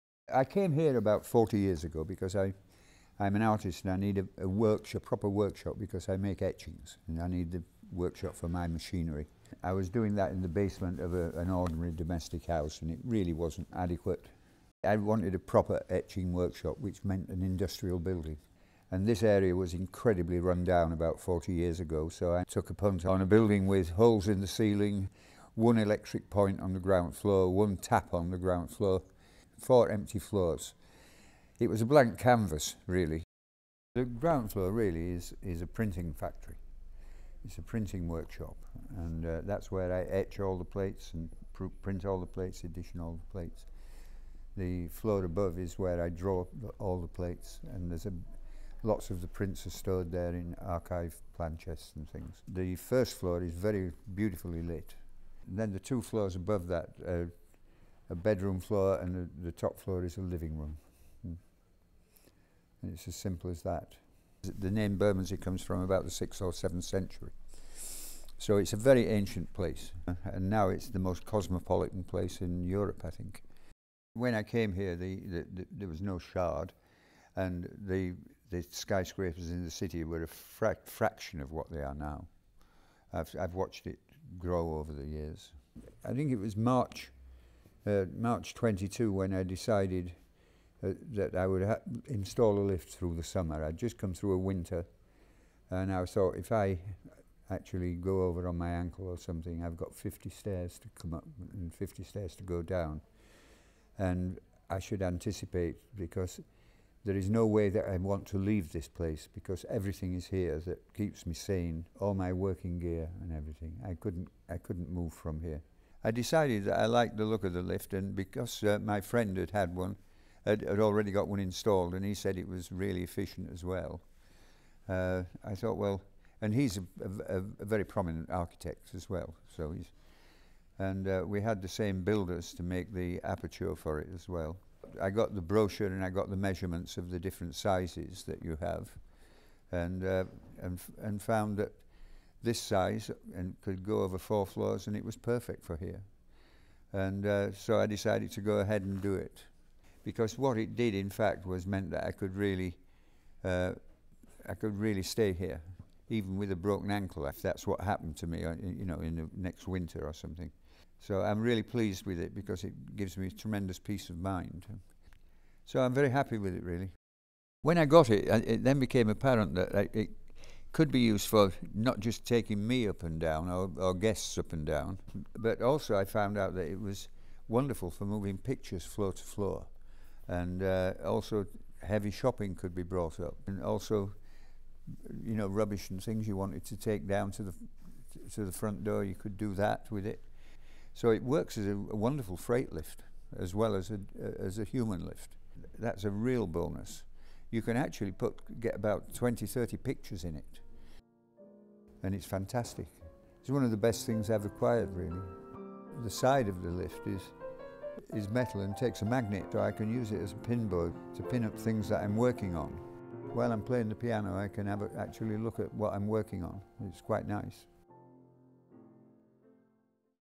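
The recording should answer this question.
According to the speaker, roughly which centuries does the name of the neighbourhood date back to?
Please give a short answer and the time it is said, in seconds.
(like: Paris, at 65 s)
6th or 7th century, at 66 s.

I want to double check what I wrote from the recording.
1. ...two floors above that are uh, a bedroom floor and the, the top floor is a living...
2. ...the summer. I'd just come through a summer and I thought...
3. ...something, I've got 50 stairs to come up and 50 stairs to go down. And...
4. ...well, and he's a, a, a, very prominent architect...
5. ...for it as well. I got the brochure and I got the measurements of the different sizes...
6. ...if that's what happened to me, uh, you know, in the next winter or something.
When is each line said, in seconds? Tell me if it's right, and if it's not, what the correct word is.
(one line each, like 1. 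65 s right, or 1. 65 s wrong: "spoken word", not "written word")
1. 55 s right
2. 93 s wrong: "winter", not "summer"
3. 99 s right
4. 125 s right
5. 133 s right
6. 157 s right.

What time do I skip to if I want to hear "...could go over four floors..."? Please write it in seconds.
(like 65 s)
143 s.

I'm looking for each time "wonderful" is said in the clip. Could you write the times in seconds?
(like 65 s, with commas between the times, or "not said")
177 s, 191 s.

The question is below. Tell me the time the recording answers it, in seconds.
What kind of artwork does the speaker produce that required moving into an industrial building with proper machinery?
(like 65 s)
6 s.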